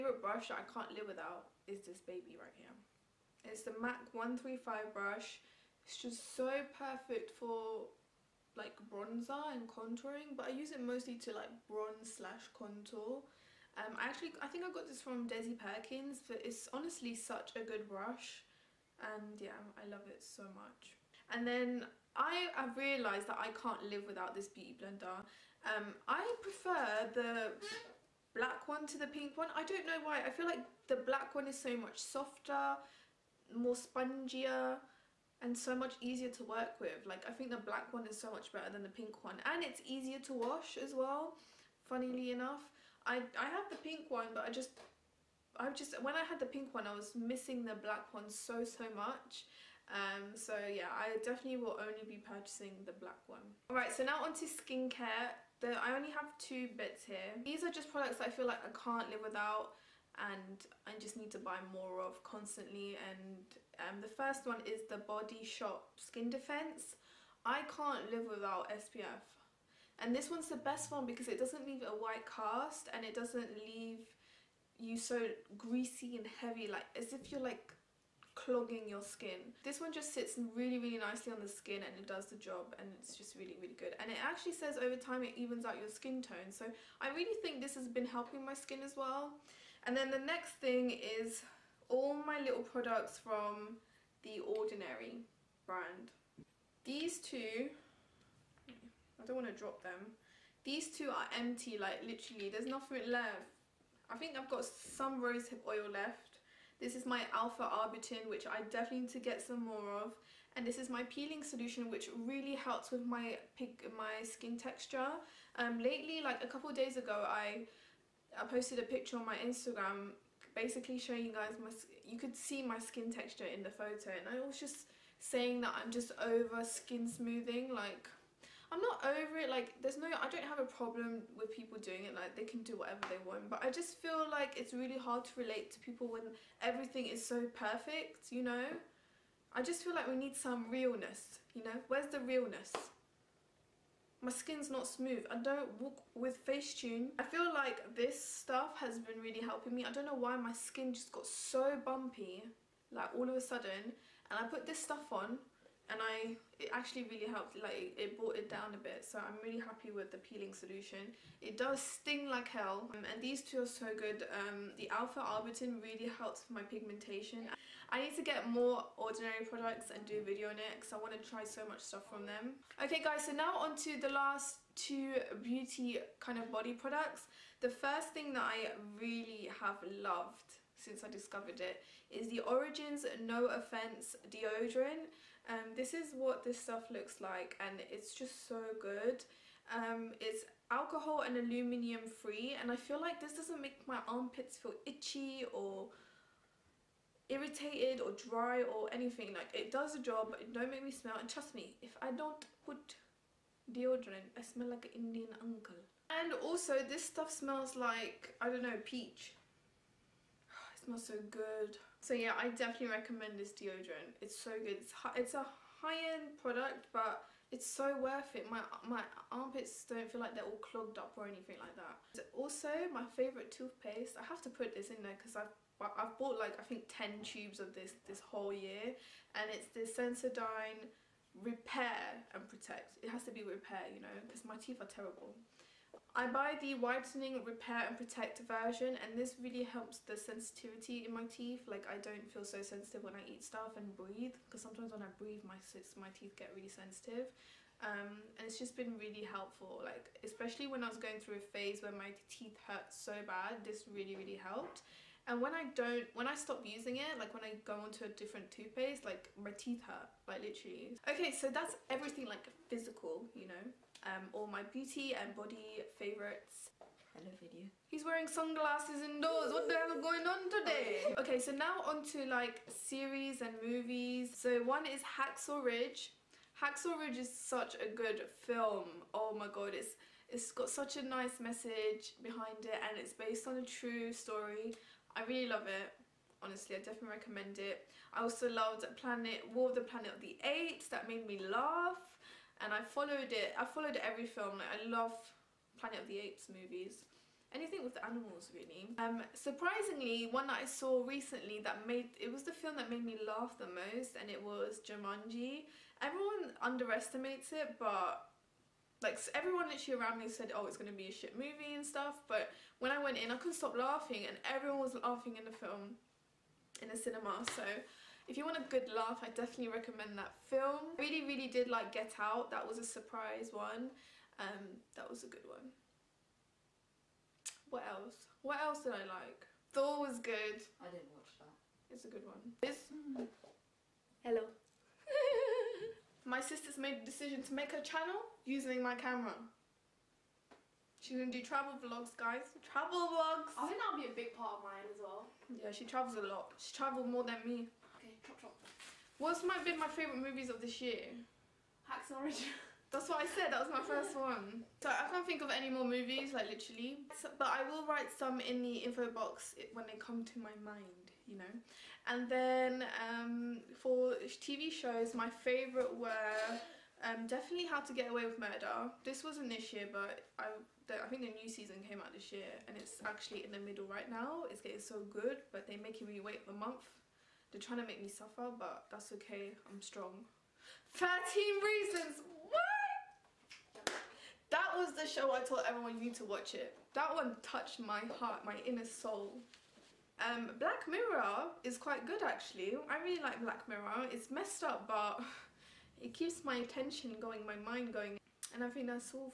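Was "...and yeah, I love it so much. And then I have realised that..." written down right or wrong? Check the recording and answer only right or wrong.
right.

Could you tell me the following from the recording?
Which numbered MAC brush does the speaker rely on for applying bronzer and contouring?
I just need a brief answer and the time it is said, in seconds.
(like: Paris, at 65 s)
MAC 135, at 3 s.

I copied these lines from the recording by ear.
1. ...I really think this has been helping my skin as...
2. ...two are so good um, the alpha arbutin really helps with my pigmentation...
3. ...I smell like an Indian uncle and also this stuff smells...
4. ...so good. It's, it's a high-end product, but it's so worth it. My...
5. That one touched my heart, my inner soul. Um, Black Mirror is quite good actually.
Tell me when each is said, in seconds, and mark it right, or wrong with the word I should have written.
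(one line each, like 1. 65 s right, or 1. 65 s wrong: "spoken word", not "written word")
1. 87 s right
2. 163 s right
3. 204 s right
4. 214 s right
5. 386 s right.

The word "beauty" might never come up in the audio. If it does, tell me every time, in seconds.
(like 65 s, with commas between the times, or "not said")
24 s, 175 s, 264 s.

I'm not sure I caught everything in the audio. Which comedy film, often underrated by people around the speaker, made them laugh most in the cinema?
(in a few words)
Jumanji.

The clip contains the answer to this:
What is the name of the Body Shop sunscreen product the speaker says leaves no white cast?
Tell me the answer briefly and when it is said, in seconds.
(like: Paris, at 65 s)
Skin Defense, at 65 s.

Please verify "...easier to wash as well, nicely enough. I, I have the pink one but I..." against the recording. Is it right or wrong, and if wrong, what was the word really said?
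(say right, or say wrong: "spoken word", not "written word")
wrong: "funnily", not "nicely".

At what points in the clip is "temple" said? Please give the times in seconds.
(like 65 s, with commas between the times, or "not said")
not said.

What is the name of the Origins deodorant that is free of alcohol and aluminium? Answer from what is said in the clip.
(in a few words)
No Offense.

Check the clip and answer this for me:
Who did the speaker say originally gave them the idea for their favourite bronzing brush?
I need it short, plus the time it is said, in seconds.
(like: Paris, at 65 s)
Desi Perkins, at 15 s.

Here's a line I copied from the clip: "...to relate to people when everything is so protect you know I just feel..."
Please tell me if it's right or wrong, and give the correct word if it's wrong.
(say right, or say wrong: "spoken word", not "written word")
wrong: "perfect", not "protect".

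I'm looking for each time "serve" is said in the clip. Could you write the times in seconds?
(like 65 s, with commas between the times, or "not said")
not said.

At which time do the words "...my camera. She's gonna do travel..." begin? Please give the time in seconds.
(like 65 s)
338 s.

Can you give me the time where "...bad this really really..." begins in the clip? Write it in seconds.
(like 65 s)
253 s.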